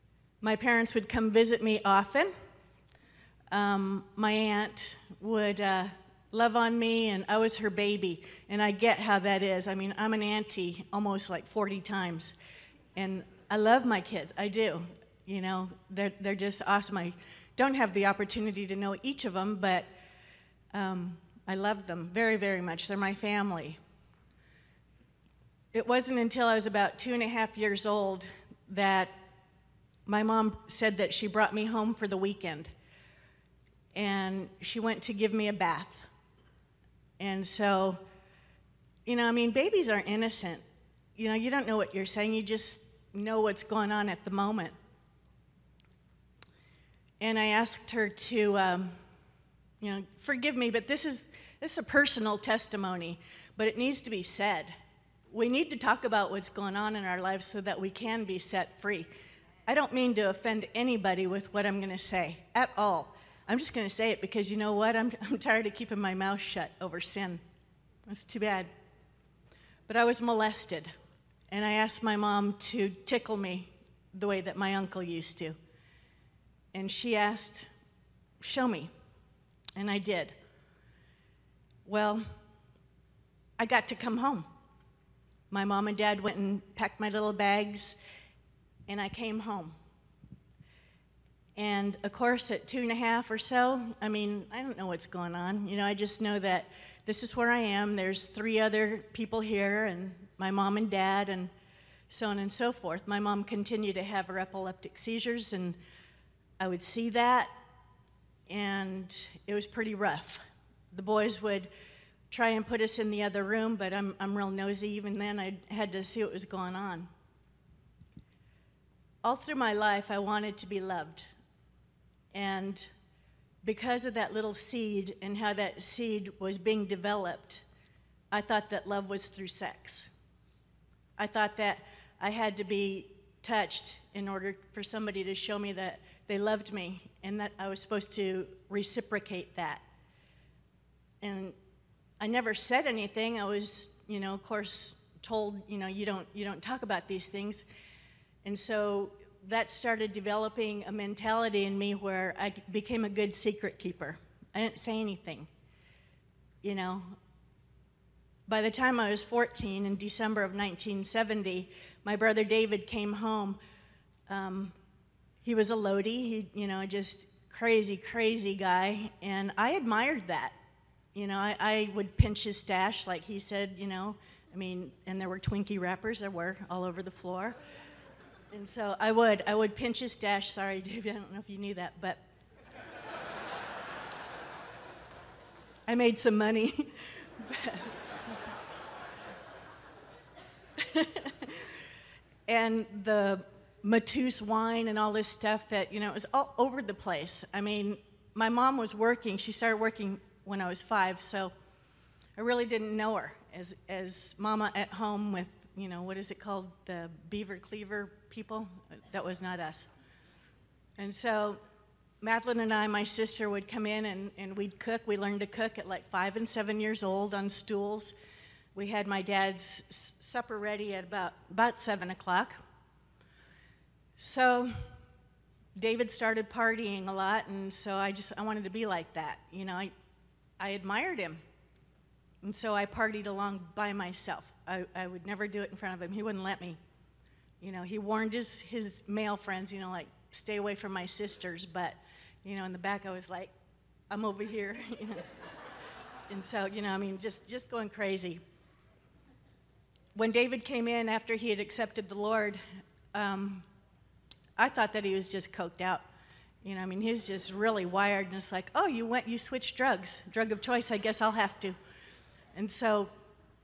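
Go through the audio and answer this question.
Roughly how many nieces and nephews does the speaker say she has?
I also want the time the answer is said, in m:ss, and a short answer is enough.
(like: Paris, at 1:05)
40, at 0:11.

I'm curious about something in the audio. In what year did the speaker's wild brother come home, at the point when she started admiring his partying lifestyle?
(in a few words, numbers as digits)
1970.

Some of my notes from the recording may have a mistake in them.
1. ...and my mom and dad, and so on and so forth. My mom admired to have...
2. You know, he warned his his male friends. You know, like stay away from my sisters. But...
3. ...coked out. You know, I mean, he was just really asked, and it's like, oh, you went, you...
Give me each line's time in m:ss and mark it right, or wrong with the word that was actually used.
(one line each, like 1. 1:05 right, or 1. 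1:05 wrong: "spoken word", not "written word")
1. 1:39 wrong: "continued", not "admired"
2. 3:57 right
3. 4:15 wrong: "wired", not "asked".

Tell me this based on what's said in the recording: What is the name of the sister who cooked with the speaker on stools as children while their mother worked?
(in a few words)
Madeline.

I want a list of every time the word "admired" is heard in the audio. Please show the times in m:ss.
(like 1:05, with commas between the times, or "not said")
2:49, 3:50.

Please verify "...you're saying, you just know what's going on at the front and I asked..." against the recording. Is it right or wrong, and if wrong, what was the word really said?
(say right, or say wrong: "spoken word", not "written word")
wrong: "moment", not "front".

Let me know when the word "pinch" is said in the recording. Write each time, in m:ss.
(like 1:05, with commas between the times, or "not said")
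2:52, 2:59.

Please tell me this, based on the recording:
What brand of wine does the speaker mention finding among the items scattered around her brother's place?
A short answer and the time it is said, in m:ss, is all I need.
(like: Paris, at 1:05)
Mateus, at 3:13.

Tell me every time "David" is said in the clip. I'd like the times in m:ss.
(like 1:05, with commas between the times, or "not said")
2:42, 3:45, 4:10.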